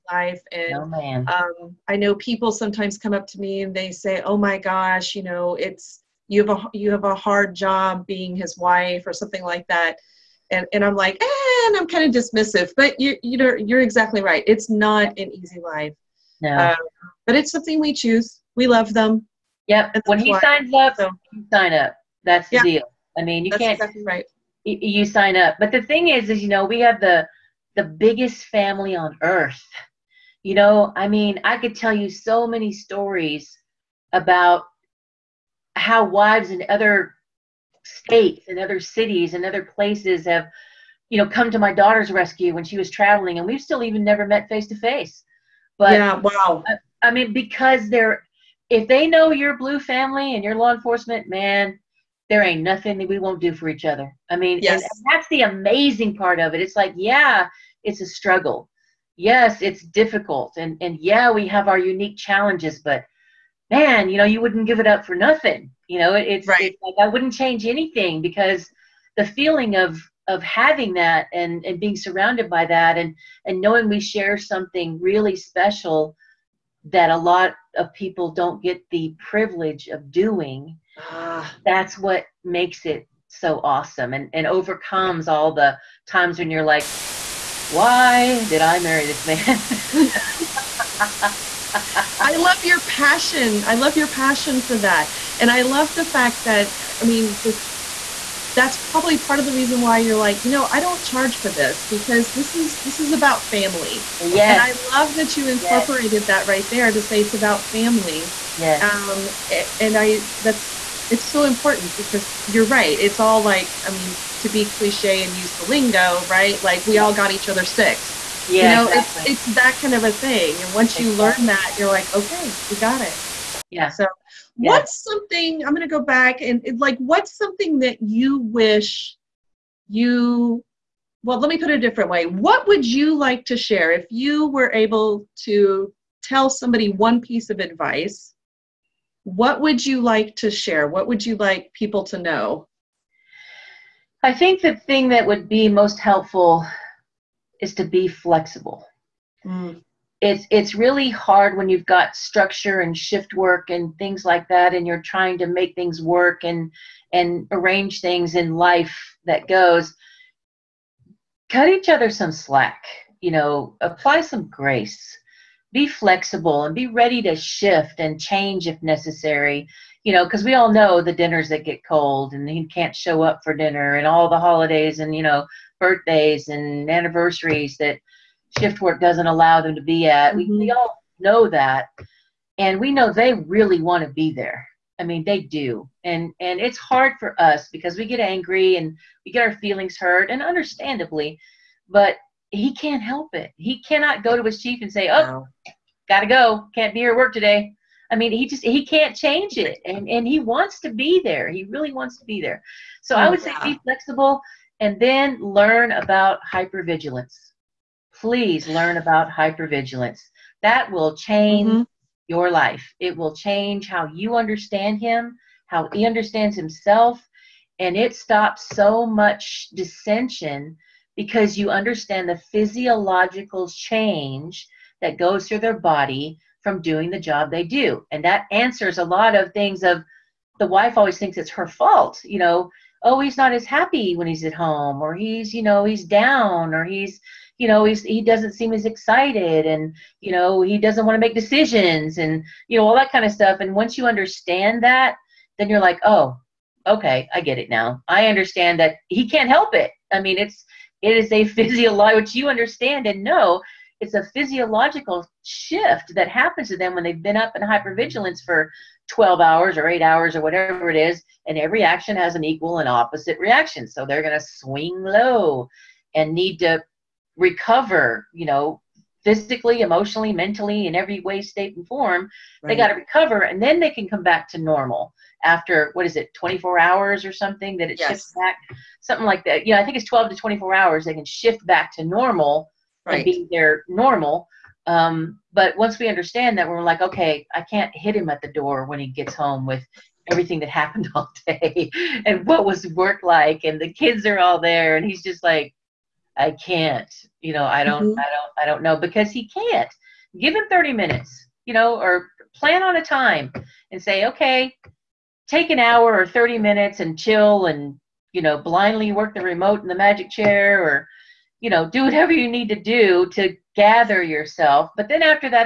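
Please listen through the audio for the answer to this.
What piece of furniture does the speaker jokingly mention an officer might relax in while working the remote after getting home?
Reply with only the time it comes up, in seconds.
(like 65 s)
309 s.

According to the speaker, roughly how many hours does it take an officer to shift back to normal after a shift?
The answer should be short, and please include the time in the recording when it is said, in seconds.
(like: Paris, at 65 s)
12 to 24 hours, at 280 s.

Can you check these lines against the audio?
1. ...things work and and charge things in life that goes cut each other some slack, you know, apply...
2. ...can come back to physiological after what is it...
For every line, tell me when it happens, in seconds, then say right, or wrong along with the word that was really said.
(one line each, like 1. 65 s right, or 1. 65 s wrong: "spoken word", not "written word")
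1. 155 s wrong: "arrange", not "charge"
2. 273 s wrong: "normal", not "physiological".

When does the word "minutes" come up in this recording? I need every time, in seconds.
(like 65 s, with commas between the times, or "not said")
300 s, 306 s.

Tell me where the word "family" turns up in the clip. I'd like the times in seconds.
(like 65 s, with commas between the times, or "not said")
28 s, 49 s, 103 s, 107 s.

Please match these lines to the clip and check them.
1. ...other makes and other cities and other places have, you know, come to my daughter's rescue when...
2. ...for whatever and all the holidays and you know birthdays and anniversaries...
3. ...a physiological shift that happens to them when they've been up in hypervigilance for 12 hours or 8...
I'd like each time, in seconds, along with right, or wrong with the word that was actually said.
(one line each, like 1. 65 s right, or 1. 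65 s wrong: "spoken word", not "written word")
1. 36 s wrong: "states", not "makes"
2. 173 s wrong: "dinner", not "whatever"
3. 254 s right.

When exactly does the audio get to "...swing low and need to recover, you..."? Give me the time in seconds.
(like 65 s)
264 s.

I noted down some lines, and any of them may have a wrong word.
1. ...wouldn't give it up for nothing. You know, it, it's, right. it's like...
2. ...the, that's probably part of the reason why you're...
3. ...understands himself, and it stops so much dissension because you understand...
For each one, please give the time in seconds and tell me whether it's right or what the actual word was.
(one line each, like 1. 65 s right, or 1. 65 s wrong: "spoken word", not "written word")
1. 64 s right
2. 97 s right
3. 216 s right.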